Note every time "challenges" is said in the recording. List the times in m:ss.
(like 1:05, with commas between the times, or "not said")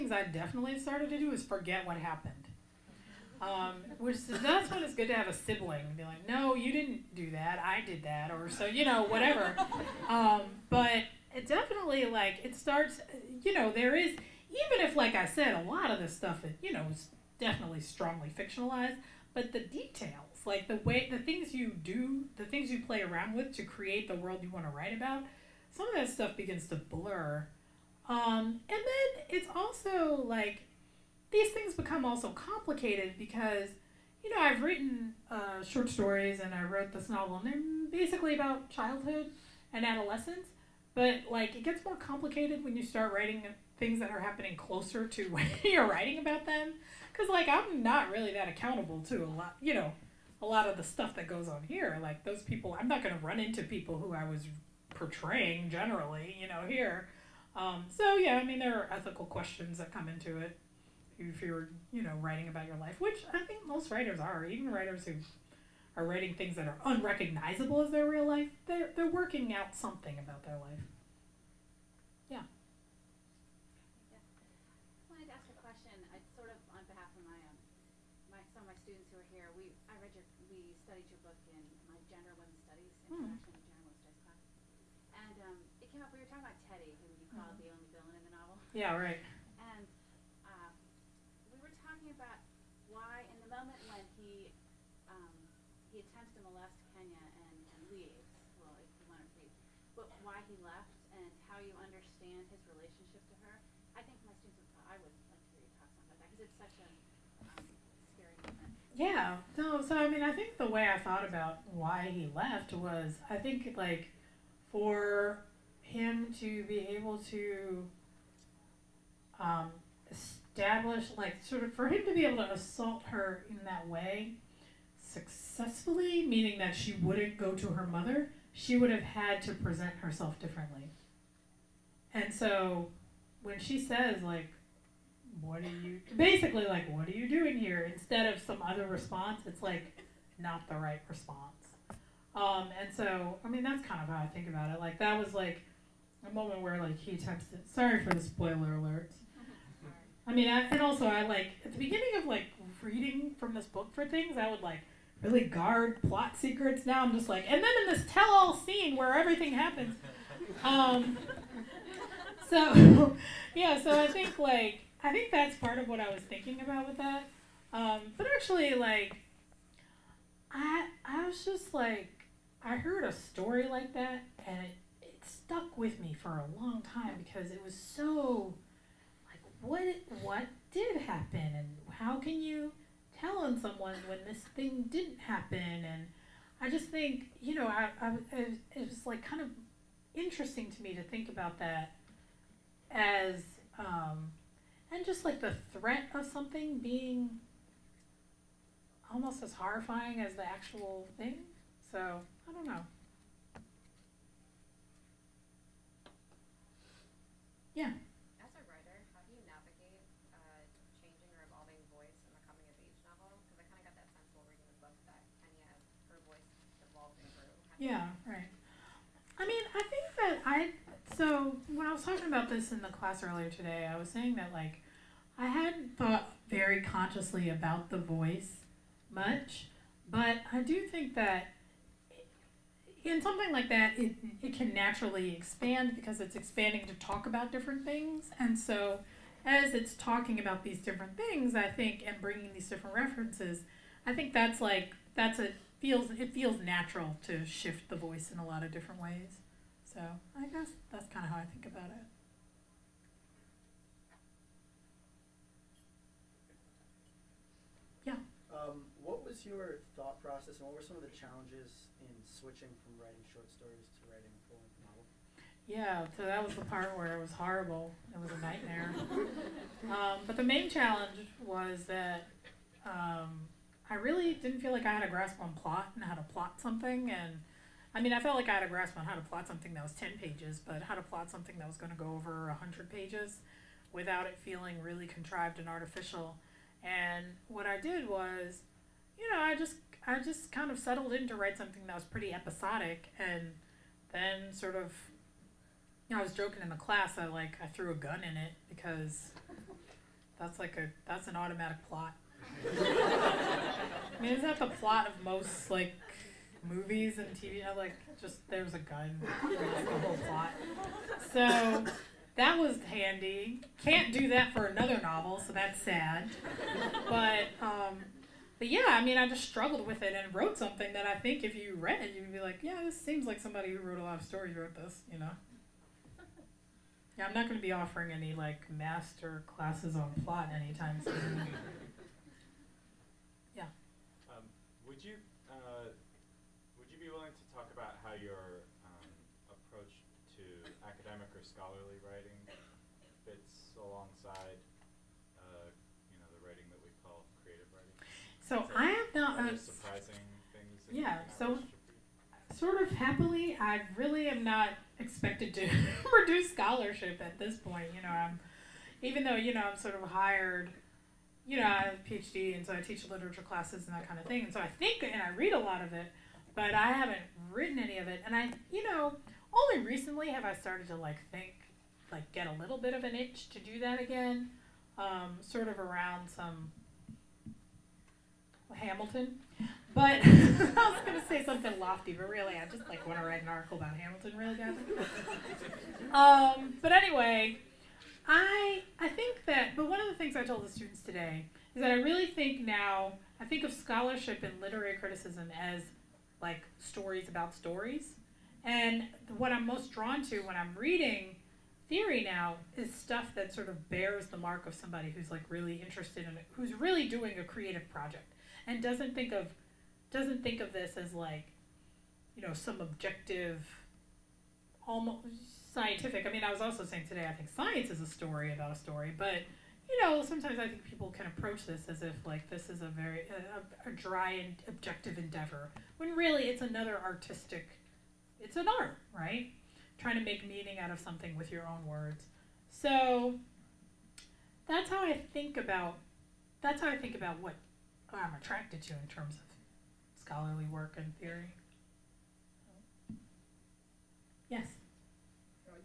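4:21, 4:30.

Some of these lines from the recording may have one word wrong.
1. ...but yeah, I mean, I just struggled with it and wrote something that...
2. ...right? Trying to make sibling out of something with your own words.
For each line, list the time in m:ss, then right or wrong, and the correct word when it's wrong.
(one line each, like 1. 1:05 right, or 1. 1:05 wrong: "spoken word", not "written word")
1. 5:18 right
2. 7:09 wrong: "meaning", not "sibling".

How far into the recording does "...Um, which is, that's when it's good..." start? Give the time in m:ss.
0:03.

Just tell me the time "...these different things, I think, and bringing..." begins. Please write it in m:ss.
4:00.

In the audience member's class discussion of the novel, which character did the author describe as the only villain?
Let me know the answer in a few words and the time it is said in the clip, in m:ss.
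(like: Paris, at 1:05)
Teddy, at 1:26.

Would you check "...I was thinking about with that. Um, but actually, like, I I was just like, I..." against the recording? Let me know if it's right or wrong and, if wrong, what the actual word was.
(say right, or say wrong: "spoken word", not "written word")
right.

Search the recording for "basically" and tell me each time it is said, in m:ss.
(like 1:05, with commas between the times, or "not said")
0:37, 2:16.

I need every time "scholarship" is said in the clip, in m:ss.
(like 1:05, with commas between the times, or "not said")
5:56, 6:33.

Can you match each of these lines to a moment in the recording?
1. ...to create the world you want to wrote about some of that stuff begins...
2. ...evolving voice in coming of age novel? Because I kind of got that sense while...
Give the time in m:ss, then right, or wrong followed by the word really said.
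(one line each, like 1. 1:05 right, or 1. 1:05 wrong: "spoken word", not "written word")
1. 0:23 wrong: "write", not "wrote"
2. 3:31 right.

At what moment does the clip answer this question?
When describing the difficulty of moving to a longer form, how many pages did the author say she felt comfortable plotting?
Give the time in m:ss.
4:39.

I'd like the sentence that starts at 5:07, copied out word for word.
You know, like just there's a gun, like the whole plot.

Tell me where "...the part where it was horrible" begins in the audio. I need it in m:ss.
4:26.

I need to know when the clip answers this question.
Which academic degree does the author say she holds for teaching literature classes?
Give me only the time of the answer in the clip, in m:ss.
6:02.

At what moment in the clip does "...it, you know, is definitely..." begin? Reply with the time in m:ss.
0:16.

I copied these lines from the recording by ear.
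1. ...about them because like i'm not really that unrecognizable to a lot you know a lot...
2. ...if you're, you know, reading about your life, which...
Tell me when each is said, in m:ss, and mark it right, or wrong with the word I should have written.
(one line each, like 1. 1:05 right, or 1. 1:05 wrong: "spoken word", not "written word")
1. 0:46 wrong: "accountable", not "unrecognizable"
2. 1:01 wrong: "writing", not "reading".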